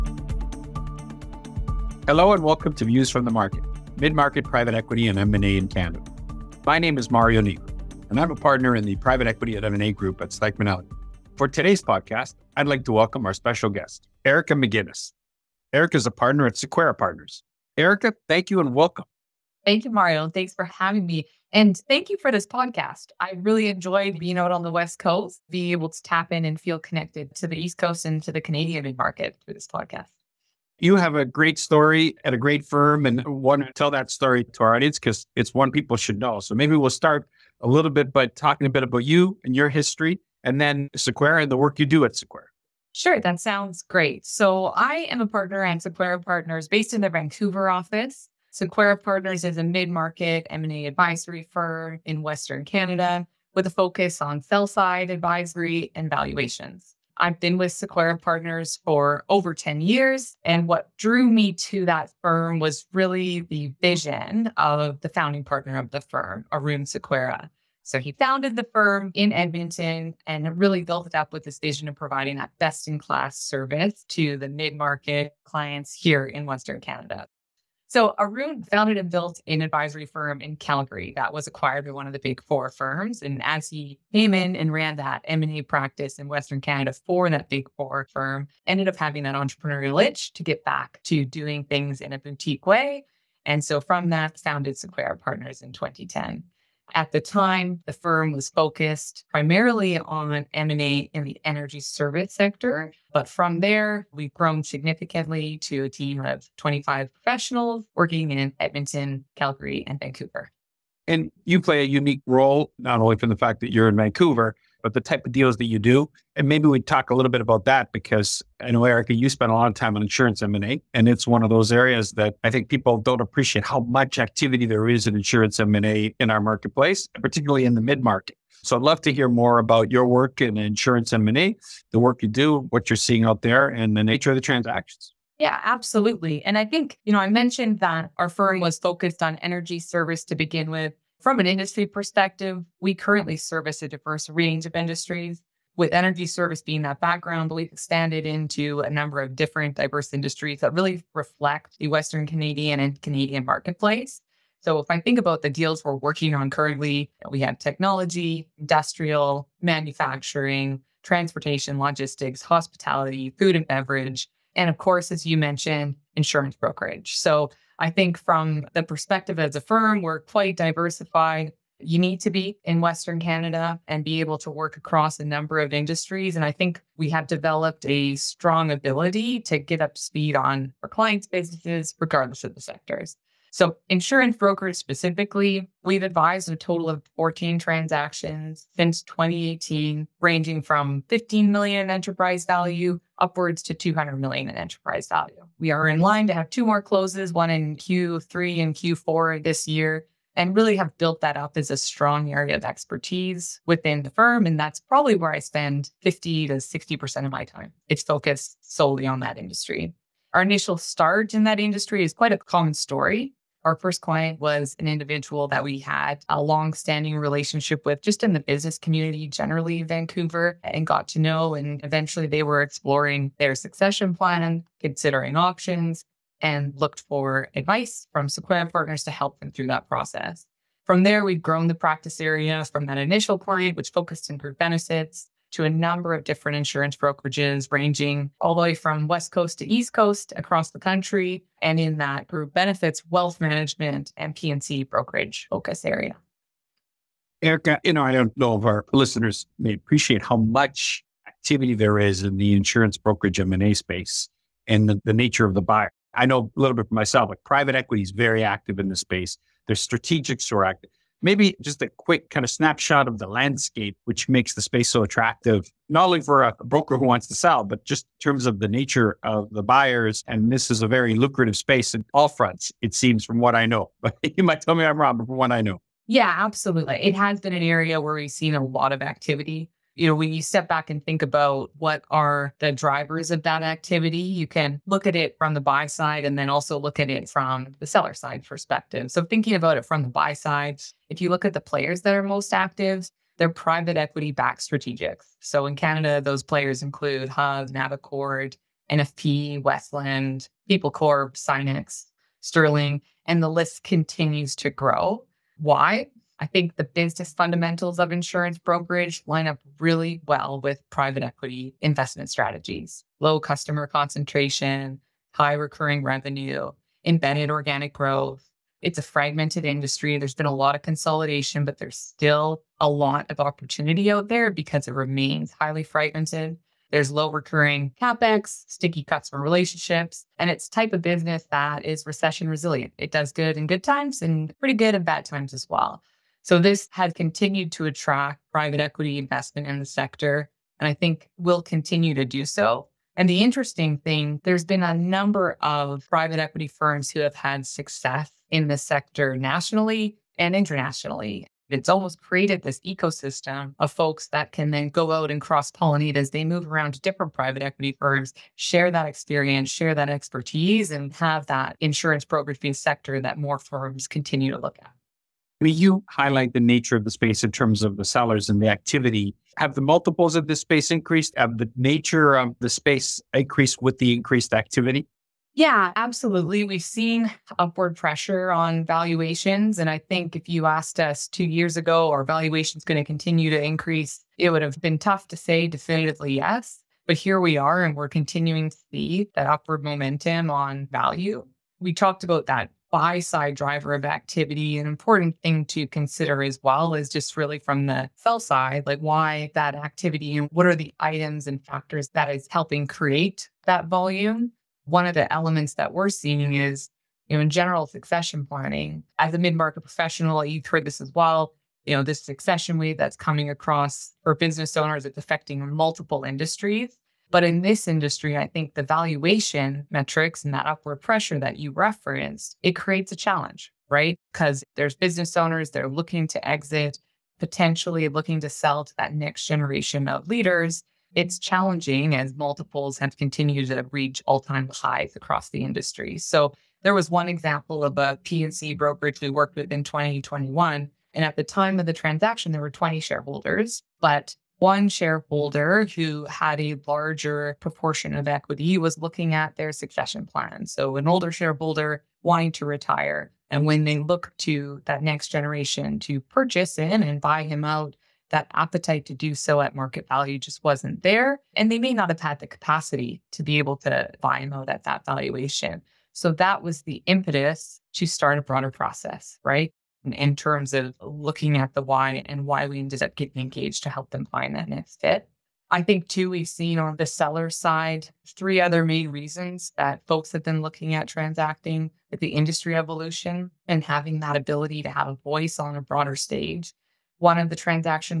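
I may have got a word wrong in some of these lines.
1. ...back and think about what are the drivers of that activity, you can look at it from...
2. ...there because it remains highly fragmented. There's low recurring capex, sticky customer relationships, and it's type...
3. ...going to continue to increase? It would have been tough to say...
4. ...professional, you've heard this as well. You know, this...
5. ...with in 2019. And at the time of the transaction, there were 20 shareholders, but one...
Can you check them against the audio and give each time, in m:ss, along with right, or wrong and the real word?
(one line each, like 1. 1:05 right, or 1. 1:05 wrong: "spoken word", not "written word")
1. 4:40 right
2. 5:24 right
3. 6:22 right
4. 6:49 right
5. 7:19 wrong: "2021", not "2019".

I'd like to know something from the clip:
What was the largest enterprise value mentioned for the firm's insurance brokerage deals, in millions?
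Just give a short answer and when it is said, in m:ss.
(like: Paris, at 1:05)
200 million, at 3:13.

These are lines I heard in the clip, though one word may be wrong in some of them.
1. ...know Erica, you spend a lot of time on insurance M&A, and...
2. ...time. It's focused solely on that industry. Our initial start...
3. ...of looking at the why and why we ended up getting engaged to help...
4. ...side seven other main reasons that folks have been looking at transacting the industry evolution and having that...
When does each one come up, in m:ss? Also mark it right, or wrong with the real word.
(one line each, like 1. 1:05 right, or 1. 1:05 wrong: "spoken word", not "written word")
1. 1:58 right
2. 3:27 right
3. 7:50 right
4. 7:57 wrong: "three", not "seven".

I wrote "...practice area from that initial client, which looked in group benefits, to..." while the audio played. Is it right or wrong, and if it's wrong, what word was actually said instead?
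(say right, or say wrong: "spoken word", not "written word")
wrong: "focused", not "looked".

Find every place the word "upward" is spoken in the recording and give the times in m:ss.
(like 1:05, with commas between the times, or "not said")
3:13, 6:17, 6:29, 7:00.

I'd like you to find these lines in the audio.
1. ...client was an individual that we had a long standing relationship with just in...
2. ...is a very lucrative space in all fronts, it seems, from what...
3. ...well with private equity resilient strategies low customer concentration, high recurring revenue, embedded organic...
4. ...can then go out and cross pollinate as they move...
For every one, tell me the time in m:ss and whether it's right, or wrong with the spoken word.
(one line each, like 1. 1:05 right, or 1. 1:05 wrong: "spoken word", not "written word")
1. 3:34 right
2. 4:30 right
3. 5:10 wrong: "investment", not "resilient"
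4. 5:54 right.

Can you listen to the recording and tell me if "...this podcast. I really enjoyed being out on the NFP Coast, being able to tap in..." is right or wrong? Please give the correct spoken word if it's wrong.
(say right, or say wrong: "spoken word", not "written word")
wrong: "West", not "NFP".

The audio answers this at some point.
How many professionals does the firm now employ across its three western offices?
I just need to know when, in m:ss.
1:46.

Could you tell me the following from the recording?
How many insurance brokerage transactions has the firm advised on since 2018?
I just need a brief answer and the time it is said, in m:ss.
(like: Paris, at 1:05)
14, at 3:07.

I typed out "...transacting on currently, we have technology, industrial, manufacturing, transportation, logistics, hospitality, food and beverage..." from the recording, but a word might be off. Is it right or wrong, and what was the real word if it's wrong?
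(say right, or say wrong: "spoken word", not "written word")
wrong: "working", not "transacting".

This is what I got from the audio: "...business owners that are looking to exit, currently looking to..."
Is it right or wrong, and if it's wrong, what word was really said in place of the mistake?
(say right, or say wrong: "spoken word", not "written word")
wrong: "potentially", not "currently".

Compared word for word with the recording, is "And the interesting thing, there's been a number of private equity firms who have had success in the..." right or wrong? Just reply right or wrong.
right.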